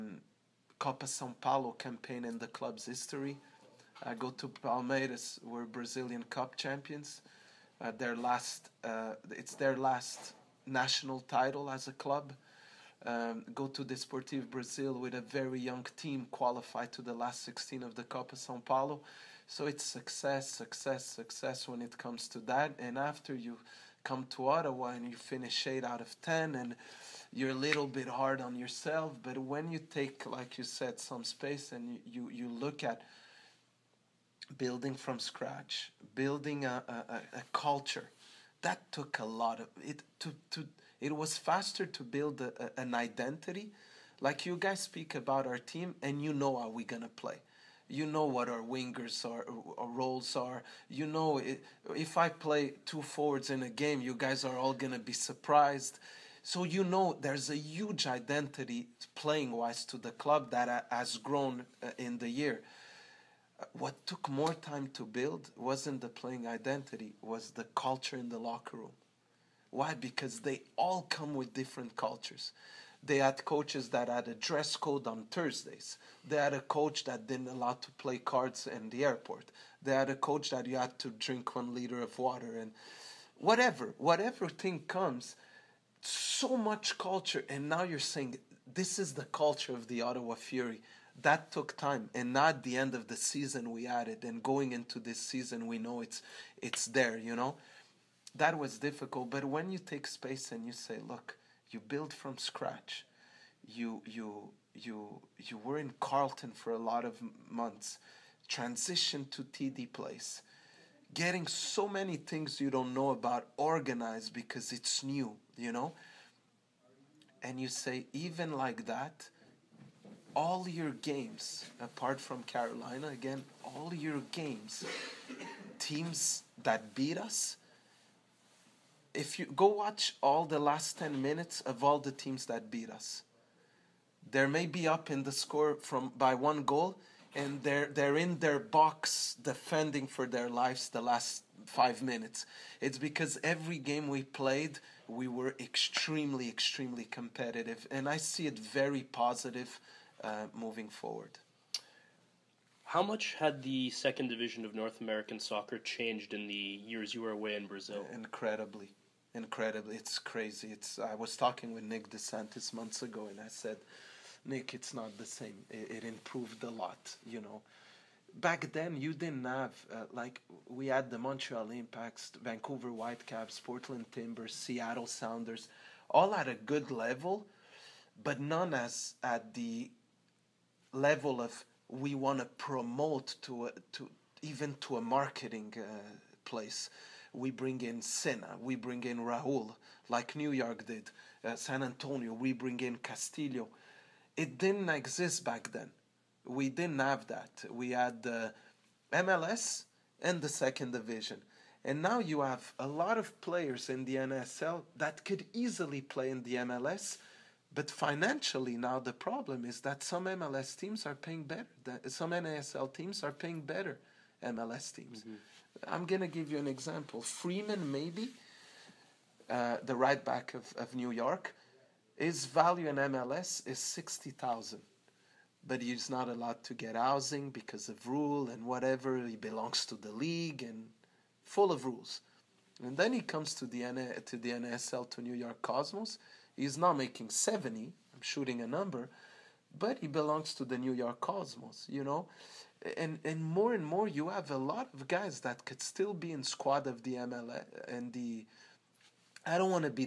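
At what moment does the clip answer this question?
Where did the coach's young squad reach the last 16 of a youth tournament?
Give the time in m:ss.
0:13.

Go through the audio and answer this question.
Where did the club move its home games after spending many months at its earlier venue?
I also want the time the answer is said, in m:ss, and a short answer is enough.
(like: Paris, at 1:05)
TD Place, at 1:49.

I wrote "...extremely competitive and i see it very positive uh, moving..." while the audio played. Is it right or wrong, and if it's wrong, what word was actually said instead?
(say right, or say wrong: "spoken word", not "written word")
right.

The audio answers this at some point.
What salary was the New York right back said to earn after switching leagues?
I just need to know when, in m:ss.
3:57.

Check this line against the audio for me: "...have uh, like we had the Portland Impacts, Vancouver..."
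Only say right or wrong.
wrong.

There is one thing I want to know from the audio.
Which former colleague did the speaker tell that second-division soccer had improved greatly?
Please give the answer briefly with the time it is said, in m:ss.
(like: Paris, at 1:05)
Nick DeSantis, at 2:41.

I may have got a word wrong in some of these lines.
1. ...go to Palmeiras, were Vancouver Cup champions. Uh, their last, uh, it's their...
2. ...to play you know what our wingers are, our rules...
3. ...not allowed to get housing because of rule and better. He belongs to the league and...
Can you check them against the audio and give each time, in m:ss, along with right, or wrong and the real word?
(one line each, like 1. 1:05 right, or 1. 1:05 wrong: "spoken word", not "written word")
1. 0:04 wrong: "Brazilian", not "Vancouver"
2. 0:47 wrong: "roles", not "rules"
3. 3:46 wrong: "whatever", not "better".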